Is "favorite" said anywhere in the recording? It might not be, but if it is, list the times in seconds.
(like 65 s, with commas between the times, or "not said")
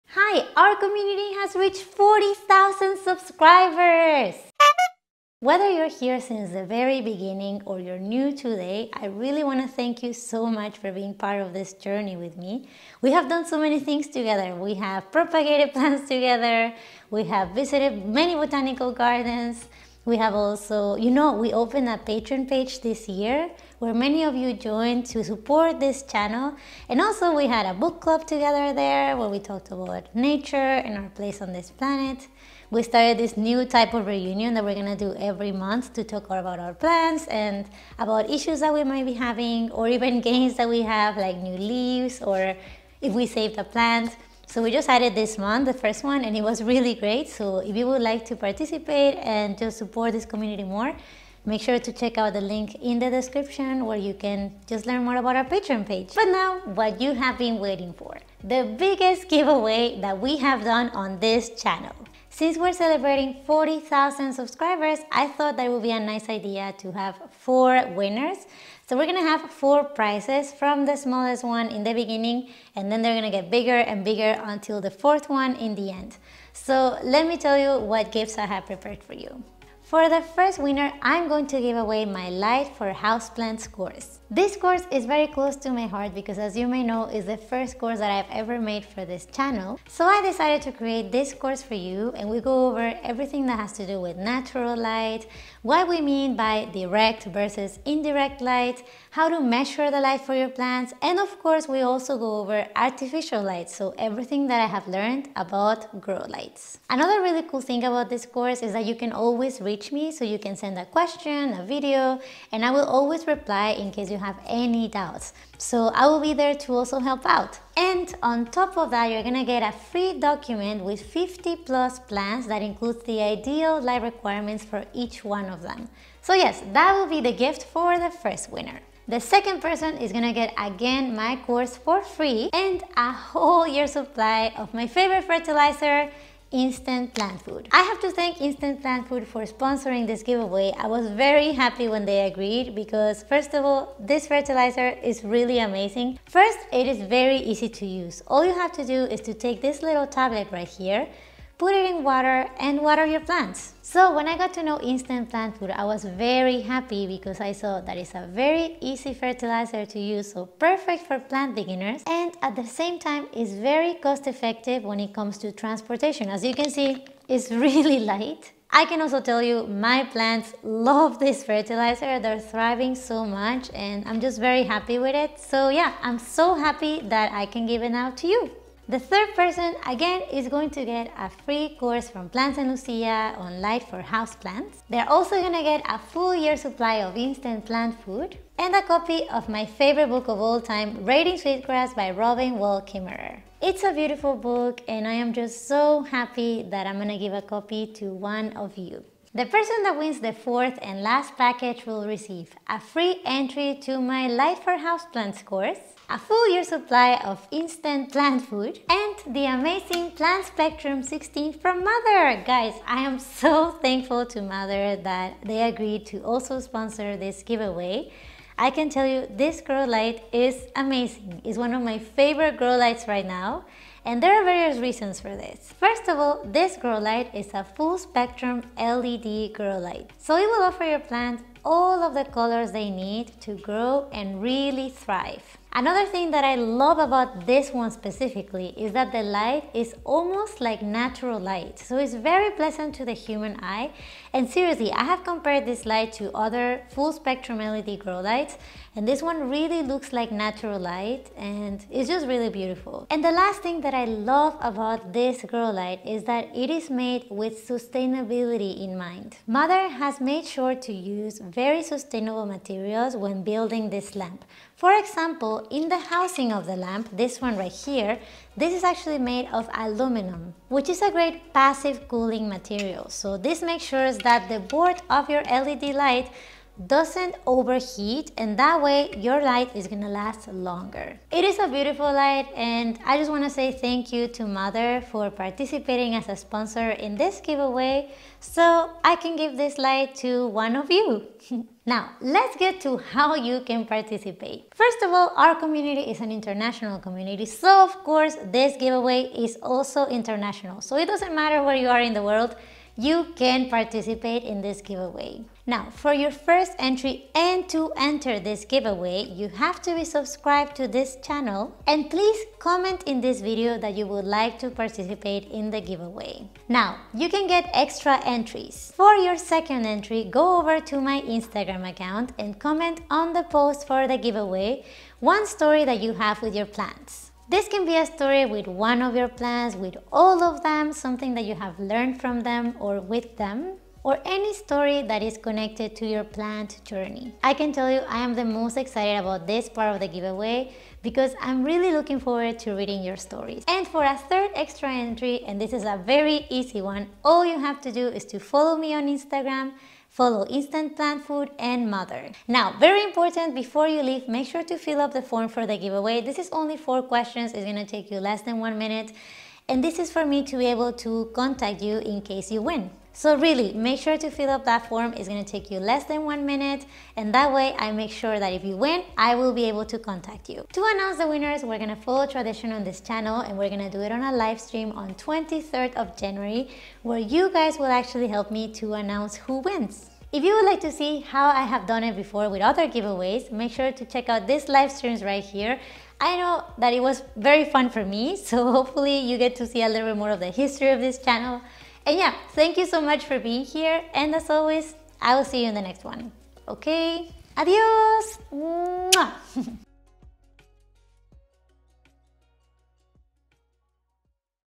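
134 s, 189 s, 221 s.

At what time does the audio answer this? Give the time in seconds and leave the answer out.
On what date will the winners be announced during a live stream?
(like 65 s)
375 s.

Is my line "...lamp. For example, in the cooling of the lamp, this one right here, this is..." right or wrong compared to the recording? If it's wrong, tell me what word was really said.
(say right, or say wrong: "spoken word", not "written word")
wrong: "housing", not "cooling".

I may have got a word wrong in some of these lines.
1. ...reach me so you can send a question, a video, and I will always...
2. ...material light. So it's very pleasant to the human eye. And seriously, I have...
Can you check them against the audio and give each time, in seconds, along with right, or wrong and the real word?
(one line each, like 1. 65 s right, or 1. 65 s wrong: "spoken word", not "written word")
1. 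109 s right
2. 240 s wrong: "natural", not "material".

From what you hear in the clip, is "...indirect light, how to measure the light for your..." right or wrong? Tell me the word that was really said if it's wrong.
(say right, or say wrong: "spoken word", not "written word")
right.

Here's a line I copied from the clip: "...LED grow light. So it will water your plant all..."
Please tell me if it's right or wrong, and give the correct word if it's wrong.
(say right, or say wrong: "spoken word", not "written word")
wrong: "offer", not "water".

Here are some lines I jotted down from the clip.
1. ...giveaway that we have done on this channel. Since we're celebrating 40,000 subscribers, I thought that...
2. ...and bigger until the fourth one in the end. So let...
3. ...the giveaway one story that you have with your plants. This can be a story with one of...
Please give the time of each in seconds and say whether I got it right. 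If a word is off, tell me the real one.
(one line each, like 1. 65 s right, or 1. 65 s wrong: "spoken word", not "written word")
1. 59 s right
2. 73 s right
3. 324 s right.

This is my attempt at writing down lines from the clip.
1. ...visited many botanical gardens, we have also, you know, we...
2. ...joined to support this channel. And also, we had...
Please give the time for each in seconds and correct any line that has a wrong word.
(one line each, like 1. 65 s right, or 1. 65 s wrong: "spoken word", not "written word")
1. 17 s right
2. 24 s right.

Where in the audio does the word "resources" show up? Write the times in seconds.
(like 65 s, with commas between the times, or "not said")
not said.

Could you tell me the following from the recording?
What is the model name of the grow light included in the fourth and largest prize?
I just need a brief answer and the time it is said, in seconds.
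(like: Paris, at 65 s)
Plant Spectrum 16, at 210 s.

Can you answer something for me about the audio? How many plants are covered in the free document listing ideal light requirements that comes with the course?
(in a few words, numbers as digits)
50+.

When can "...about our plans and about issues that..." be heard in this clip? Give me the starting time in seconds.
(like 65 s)
36 s.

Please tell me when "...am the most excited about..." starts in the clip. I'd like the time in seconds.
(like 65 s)
338 s.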